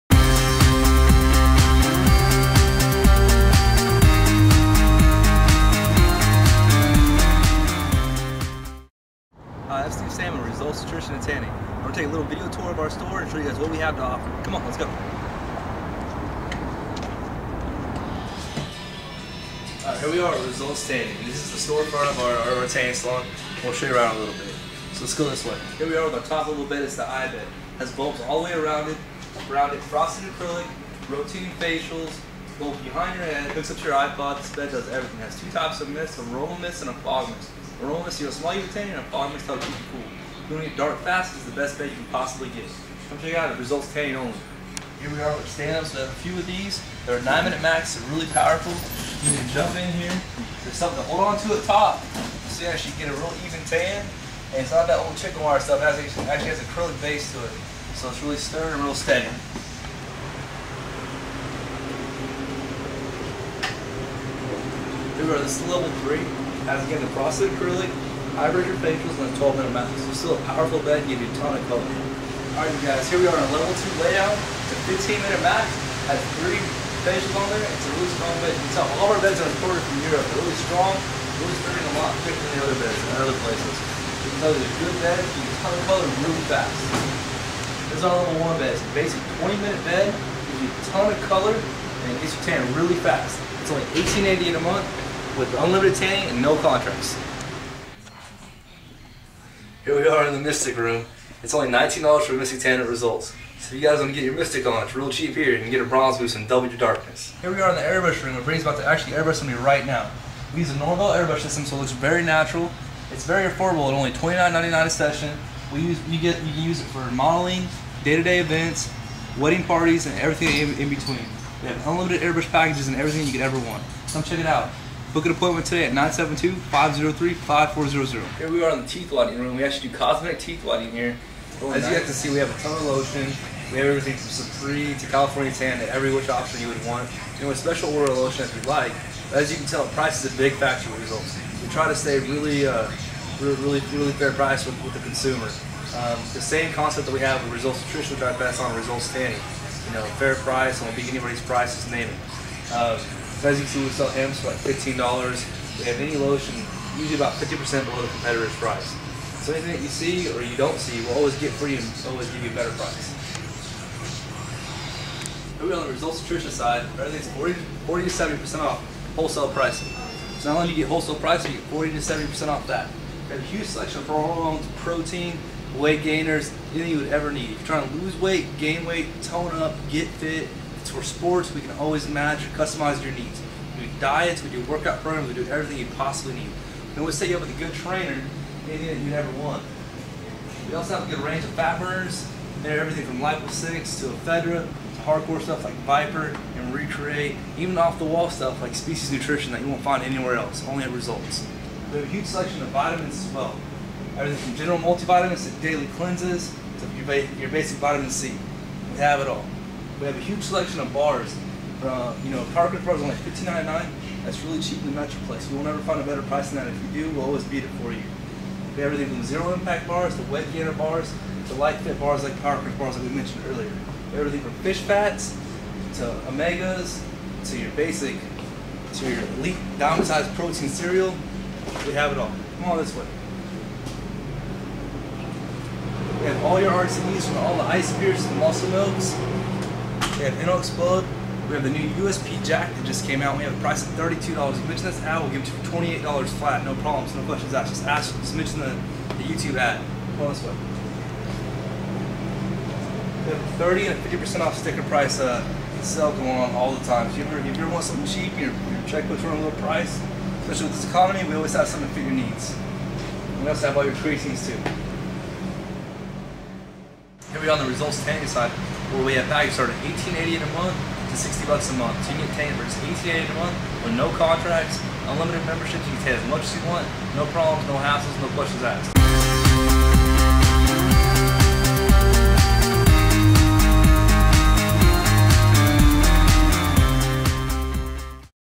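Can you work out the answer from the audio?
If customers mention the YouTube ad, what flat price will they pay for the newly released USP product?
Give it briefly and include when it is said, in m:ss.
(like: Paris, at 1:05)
$28, at 4:05.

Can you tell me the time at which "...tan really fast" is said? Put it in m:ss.
1:32.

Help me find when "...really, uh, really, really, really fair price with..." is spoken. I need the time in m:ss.
2:22.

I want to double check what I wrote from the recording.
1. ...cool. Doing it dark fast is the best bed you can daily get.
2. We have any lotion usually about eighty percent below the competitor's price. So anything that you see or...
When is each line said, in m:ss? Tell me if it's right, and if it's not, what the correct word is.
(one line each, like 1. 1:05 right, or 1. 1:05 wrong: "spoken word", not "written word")
1. 0:39 wrong: "possibly", not "daily"
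2. 2:35 wrong: "fifty", not "eighty".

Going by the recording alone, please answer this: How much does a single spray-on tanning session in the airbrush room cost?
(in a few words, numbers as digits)
$29.99.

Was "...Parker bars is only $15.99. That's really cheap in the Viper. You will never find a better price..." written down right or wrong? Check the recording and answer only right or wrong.
wrong.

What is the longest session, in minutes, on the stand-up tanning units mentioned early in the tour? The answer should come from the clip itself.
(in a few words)
9 minutes.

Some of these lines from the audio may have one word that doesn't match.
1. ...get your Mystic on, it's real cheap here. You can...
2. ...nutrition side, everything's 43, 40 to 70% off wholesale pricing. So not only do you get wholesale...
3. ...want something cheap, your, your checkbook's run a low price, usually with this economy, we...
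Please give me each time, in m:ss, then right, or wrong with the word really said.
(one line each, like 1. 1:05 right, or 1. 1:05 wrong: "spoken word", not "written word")
1. 1:44 right
2. 2:46 wrong: "40", not "43"
3. 4:17 wrong: "especially", not "usually".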